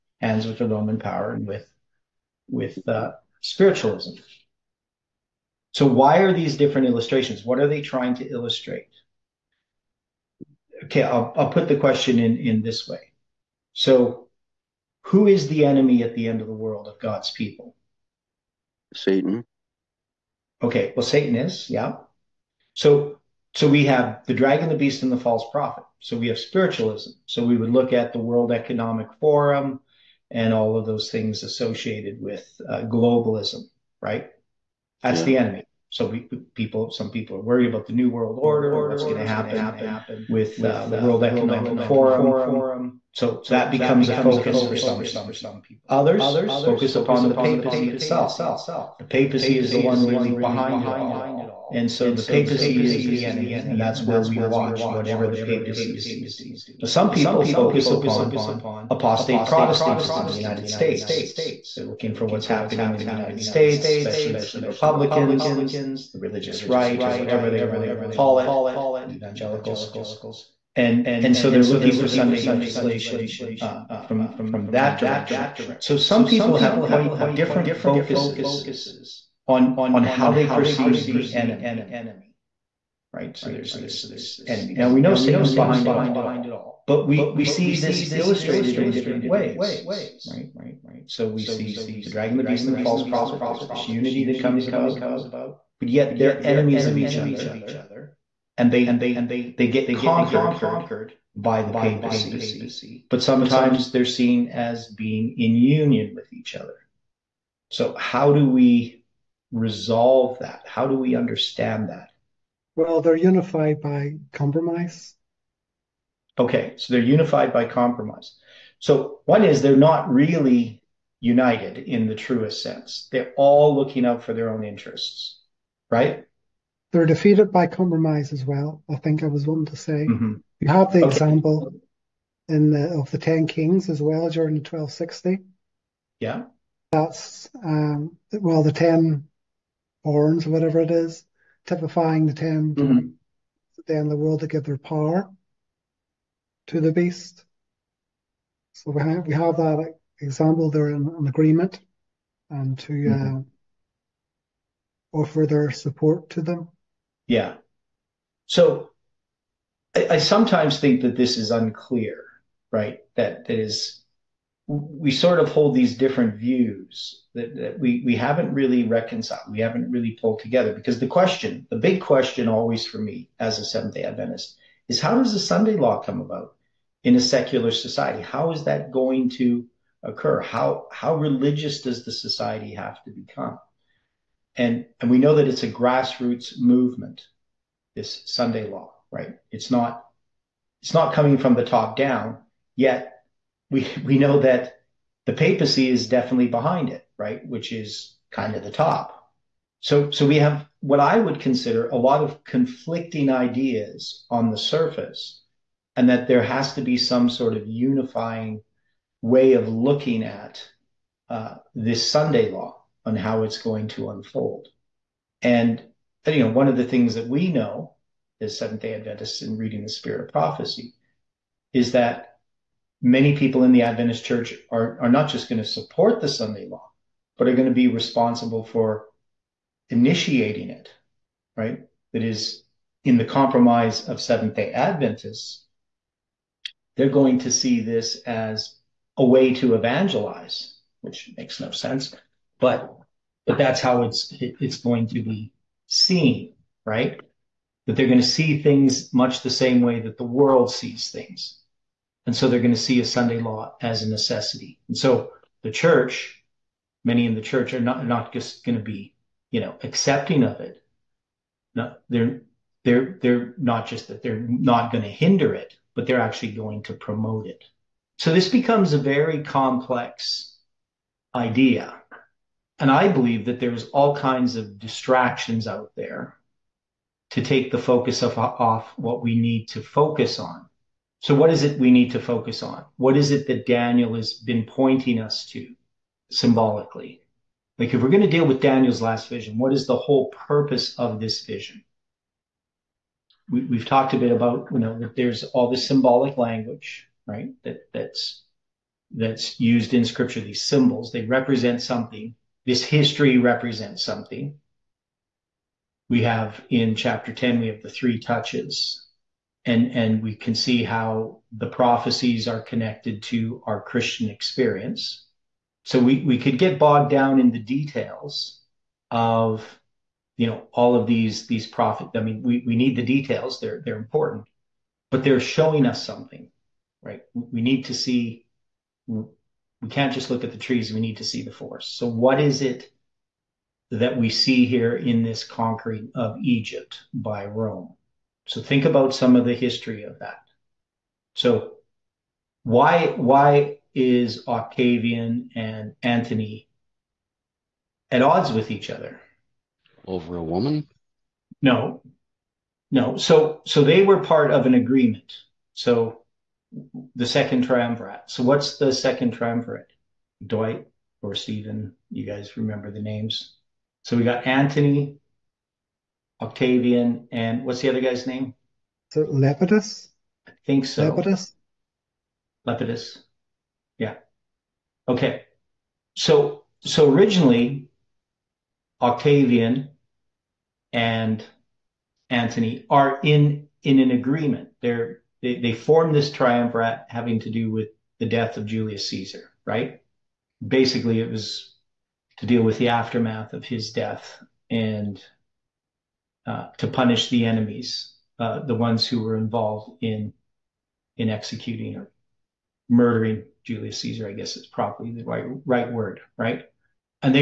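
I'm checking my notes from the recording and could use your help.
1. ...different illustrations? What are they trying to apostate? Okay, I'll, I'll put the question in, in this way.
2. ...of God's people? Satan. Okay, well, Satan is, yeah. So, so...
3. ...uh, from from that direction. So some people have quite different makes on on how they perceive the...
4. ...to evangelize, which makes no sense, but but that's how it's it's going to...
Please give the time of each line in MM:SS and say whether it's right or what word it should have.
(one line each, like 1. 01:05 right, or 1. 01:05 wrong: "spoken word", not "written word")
1. 00:06 wrong: "illustrate", not "apostate"
2. 00:16 right
3. 01:13 wrong: "focuses", not "makes"
4. 03:59 right.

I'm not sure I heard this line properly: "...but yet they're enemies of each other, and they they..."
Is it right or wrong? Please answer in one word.
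right.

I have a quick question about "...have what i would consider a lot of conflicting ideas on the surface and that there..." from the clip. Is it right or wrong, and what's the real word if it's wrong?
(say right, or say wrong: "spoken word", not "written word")
right.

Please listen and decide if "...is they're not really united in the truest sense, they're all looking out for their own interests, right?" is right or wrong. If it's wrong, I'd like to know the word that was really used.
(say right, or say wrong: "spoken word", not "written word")
right.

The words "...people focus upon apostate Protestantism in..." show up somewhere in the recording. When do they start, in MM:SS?
00:57.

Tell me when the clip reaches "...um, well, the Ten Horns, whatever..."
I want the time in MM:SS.
02:17.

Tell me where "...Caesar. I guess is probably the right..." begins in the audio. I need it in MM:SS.
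06:43.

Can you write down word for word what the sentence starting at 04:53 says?
We, we've talked a bit about, you know, that there's all this symbolic language, right?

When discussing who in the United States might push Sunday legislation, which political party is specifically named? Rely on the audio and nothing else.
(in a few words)
Republicans.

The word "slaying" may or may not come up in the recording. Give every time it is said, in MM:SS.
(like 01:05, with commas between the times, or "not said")
not said.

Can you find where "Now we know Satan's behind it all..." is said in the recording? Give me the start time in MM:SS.
01:24.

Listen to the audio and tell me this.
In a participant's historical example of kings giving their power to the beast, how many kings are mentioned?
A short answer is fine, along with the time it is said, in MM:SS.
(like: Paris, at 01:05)
10, at 02:13.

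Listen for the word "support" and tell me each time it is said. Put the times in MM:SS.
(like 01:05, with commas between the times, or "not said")
02:35, 03:45.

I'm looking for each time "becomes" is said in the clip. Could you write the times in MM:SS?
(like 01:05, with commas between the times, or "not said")
00:43, 03:03, 04:28.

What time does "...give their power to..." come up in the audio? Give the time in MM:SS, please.
02:24.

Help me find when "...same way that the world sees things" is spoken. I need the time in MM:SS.
04:09.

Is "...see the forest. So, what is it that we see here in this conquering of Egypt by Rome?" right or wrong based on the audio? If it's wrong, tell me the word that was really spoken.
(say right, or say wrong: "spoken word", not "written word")
right.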